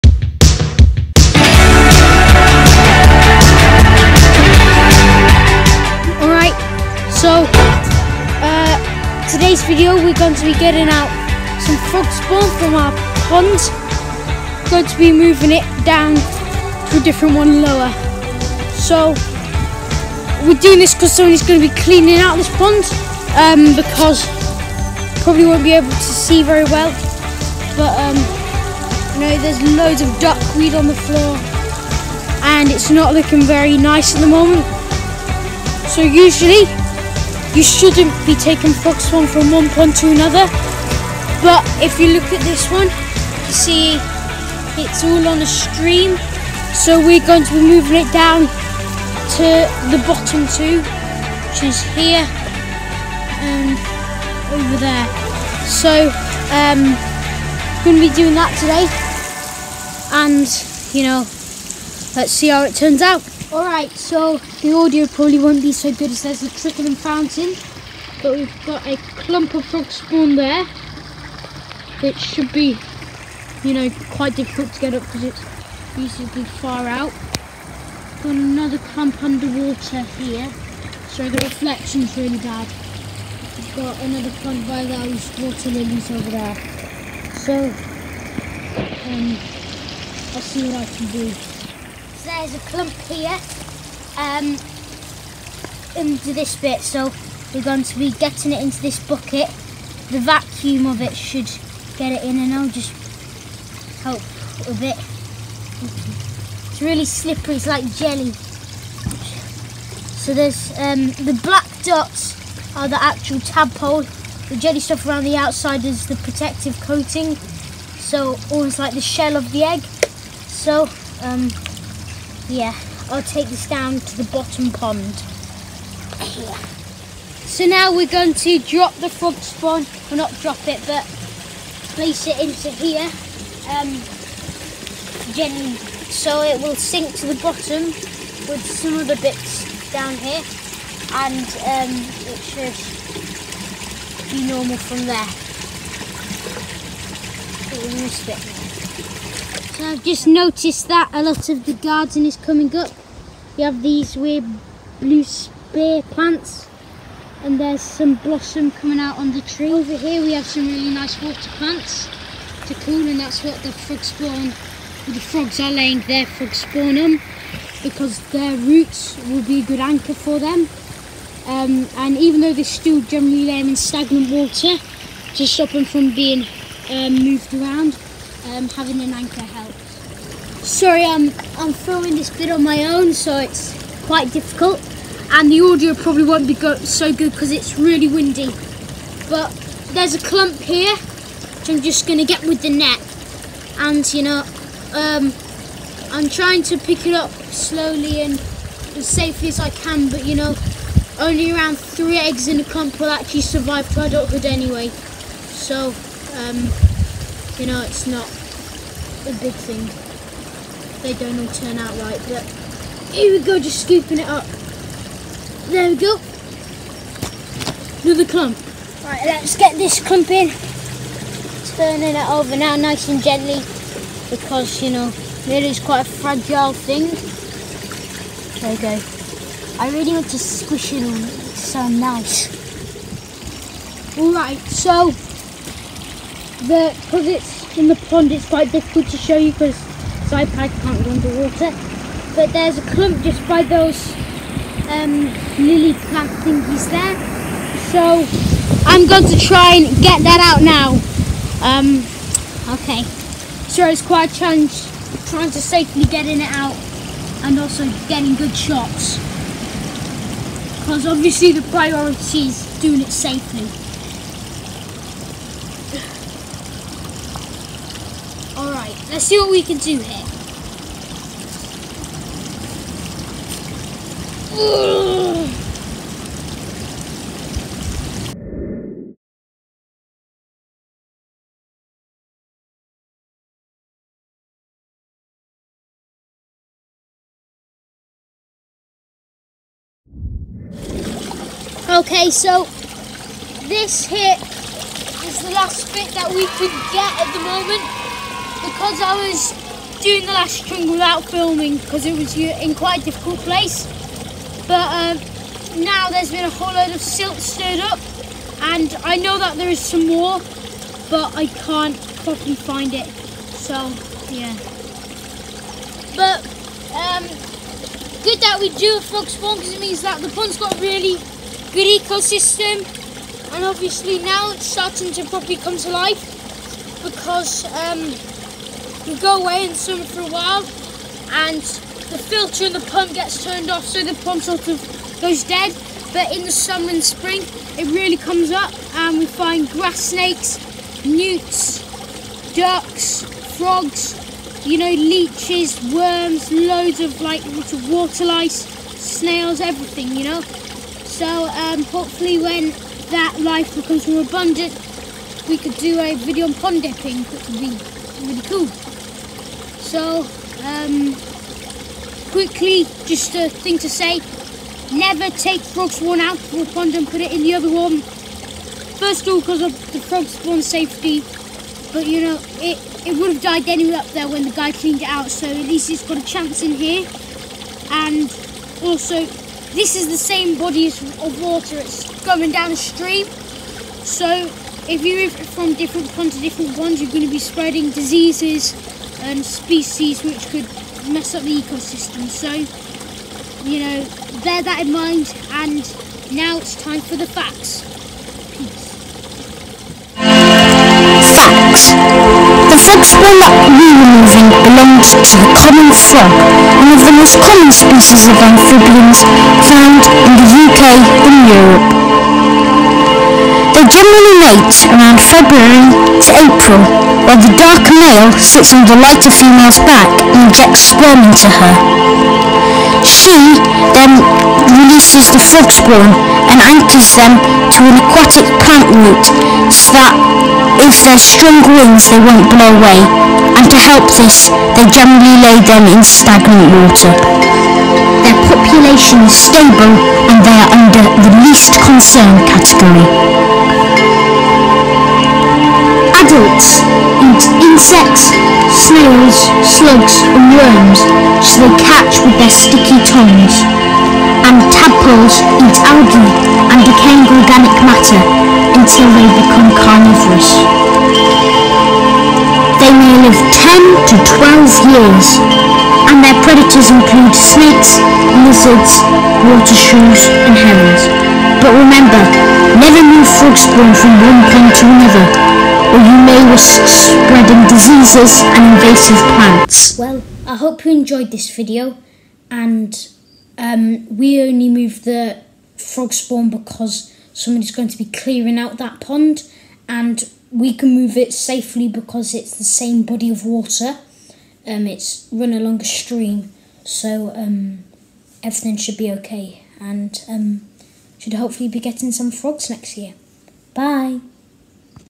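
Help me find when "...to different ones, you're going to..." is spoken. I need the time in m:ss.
6:26.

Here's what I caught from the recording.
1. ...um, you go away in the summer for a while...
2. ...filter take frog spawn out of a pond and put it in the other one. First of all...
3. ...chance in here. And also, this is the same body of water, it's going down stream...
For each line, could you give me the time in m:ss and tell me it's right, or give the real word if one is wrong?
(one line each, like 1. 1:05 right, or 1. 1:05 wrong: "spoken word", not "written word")
1. 5:27 right
2. 6:04 wrong: "never", not "filter"
3. 6:16 right.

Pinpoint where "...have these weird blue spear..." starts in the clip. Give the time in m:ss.
2:33.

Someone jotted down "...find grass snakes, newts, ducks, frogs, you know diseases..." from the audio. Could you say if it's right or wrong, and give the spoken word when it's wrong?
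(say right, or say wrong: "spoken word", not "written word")
wrong: "leeches", not "diseases".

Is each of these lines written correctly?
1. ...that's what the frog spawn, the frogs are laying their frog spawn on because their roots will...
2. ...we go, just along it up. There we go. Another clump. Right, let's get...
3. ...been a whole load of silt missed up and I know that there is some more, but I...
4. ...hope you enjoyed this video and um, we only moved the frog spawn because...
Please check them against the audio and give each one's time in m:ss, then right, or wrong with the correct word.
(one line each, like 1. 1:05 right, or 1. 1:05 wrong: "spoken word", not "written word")
1. 2:43 right
2. 3:33 wrong: "scooping", not "along"
3. 5:06 wrong: "stirred", not "missed"
4. 8:00 right.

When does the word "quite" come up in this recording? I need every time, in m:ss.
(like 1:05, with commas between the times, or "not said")
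1:14, 3:04, 3:45, 3:58, 4:14, 5:02.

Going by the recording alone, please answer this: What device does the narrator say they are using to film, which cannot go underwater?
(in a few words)
iPad.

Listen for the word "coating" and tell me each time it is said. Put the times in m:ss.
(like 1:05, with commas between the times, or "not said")
1:56.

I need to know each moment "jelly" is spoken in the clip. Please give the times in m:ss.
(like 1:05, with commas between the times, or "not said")
1:47, 1:54.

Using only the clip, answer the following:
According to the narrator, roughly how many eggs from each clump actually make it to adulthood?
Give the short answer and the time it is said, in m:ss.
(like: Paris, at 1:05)
3, at 3:21.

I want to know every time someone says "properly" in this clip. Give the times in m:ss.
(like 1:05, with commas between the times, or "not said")
5:12, 5:25.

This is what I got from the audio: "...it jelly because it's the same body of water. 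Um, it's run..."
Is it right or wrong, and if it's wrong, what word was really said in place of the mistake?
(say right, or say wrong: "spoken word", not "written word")
wrong: "safely", not "jelly".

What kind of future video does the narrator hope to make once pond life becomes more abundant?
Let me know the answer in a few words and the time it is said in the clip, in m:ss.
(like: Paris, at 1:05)
Pond dipping, at 5:56.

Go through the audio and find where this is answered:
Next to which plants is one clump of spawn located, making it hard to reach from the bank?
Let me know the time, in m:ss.
1:25.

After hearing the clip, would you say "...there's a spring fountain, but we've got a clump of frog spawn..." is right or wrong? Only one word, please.
wrong.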